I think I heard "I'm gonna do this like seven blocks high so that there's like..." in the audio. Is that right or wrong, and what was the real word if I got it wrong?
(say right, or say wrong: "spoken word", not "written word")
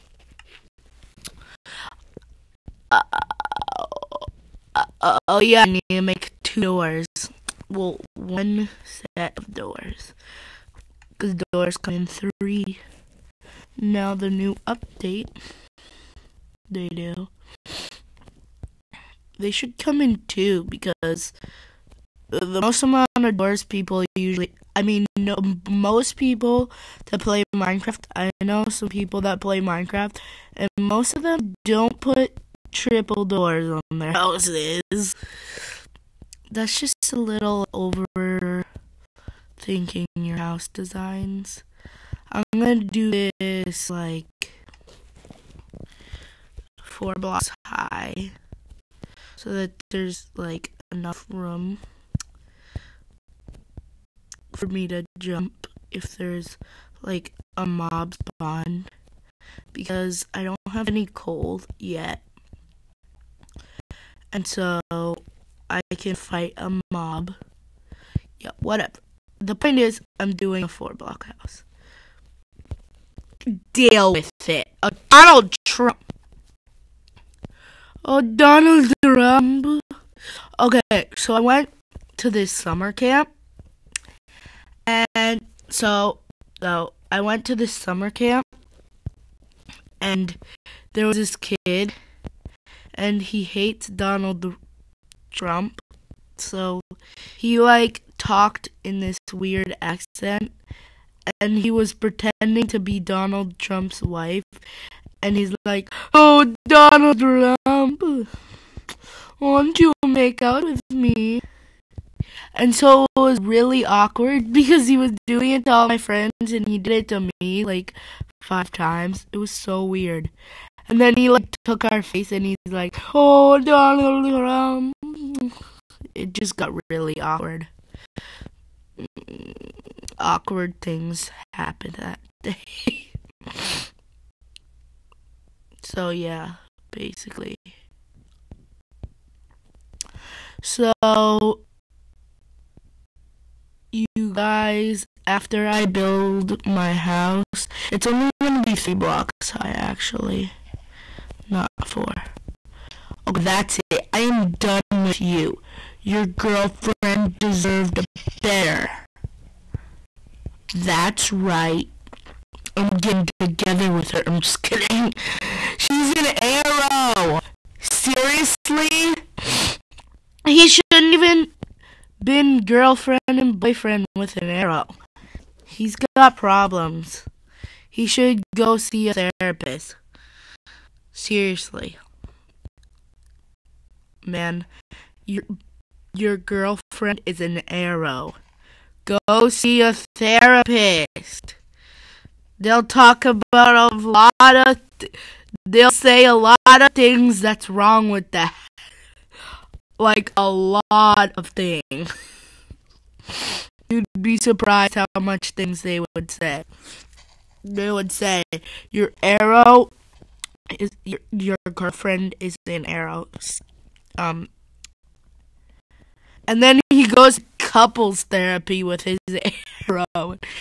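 wrong: "four", not "seven".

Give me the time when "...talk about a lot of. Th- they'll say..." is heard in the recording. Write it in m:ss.
3:12.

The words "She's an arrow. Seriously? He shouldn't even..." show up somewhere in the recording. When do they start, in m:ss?
2:45.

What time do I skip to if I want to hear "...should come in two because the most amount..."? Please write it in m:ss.
0:19.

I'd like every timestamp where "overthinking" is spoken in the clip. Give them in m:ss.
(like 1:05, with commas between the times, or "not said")
0:37.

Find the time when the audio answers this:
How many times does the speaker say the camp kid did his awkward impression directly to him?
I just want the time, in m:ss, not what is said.
1:58.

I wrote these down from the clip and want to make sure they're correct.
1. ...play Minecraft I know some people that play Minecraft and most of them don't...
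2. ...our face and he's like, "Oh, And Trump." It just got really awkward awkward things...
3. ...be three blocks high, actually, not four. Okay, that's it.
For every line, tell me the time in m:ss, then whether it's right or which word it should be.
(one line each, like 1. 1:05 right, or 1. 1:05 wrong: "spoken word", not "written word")
1. 0:27 right
2. 2:01 wrong: "Donald", not "And"
3. 2:28 right.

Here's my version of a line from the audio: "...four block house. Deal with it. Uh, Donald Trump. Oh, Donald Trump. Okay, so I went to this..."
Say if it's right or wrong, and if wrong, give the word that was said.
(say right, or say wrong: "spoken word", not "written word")
right.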